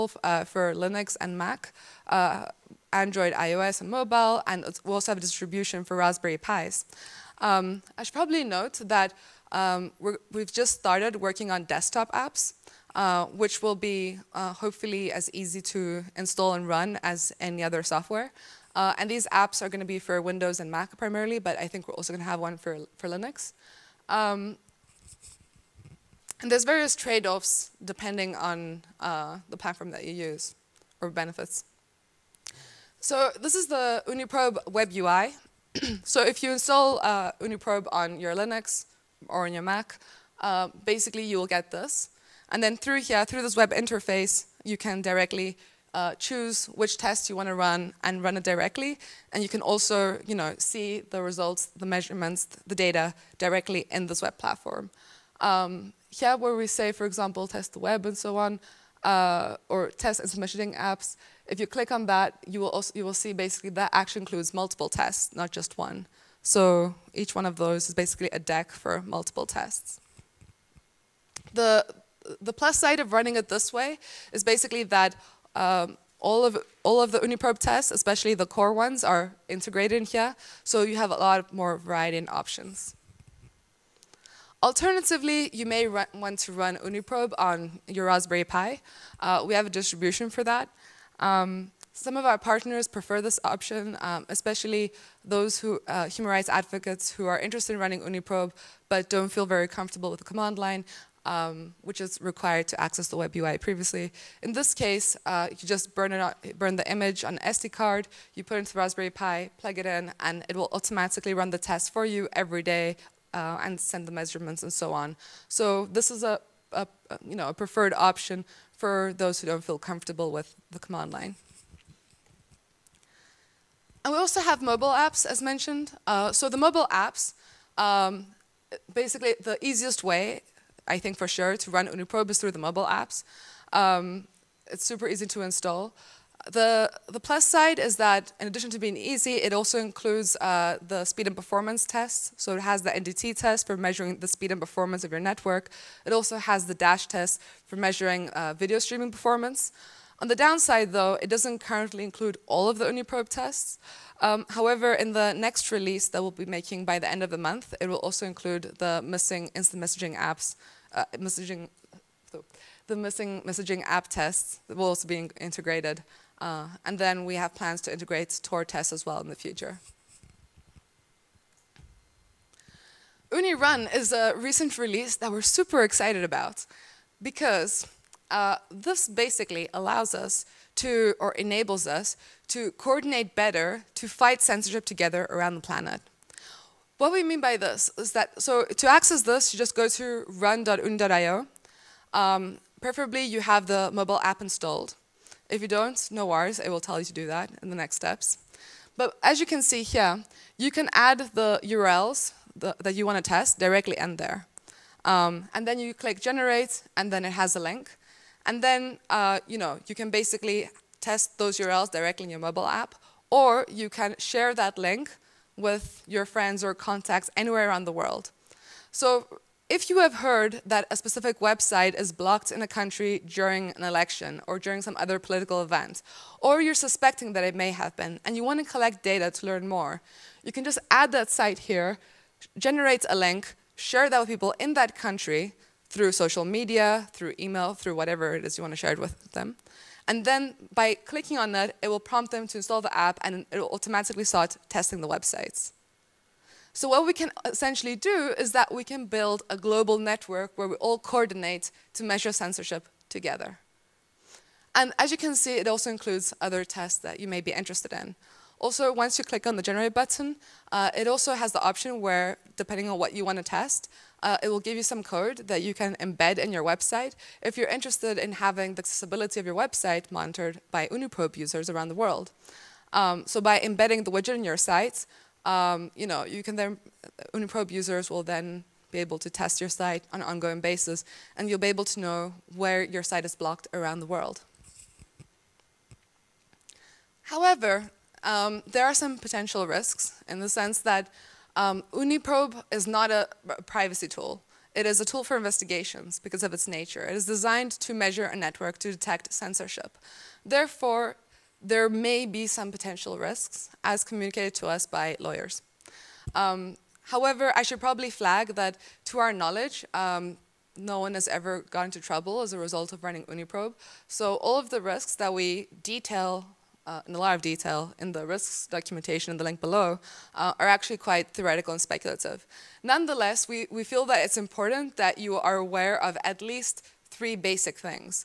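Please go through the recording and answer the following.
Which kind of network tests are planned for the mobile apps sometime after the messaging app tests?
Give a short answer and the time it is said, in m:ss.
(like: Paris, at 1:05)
Tor tests, at 2:48.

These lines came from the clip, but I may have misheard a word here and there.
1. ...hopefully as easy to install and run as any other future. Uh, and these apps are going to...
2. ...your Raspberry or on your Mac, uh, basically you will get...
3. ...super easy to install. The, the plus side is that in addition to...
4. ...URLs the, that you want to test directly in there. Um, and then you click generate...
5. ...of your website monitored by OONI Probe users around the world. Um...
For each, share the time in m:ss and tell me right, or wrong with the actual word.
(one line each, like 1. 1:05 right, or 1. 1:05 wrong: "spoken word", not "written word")
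1. 0:14 wrong: "software", not "future"
2. 0:38 wrong: "Linux", not "Raspberry"
3. 2:14 right
4. 3:21 right
5. 4:29 right.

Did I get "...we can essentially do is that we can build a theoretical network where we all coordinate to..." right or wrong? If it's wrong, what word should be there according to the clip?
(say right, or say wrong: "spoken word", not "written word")
wrong: "global", not "theoretical".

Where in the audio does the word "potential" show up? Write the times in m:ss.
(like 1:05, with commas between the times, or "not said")
4:49, 5:02.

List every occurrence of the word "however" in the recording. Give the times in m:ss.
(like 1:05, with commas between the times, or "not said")
2:34, 4:47, 5:07.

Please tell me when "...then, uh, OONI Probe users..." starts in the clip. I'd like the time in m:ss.
4:36.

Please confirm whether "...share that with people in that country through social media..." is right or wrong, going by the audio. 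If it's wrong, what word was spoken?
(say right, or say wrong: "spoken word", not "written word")
right.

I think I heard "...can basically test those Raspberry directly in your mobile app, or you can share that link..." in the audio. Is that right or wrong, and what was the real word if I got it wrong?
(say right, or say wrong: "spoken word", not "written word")
wrong: "URLs", not "Raspberry".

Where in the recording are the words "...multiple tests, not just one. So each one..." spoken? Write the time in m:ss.
1:04.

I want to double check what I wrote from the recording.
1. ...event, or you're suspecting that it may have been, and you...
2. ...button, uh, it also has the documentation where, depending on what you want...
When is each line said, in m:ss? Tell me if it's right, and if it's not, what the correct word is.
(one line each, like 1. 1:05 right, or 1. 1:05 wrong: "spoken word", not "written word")
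1. 3:45 right
2. 4:19 wrong: "option", not "documentation".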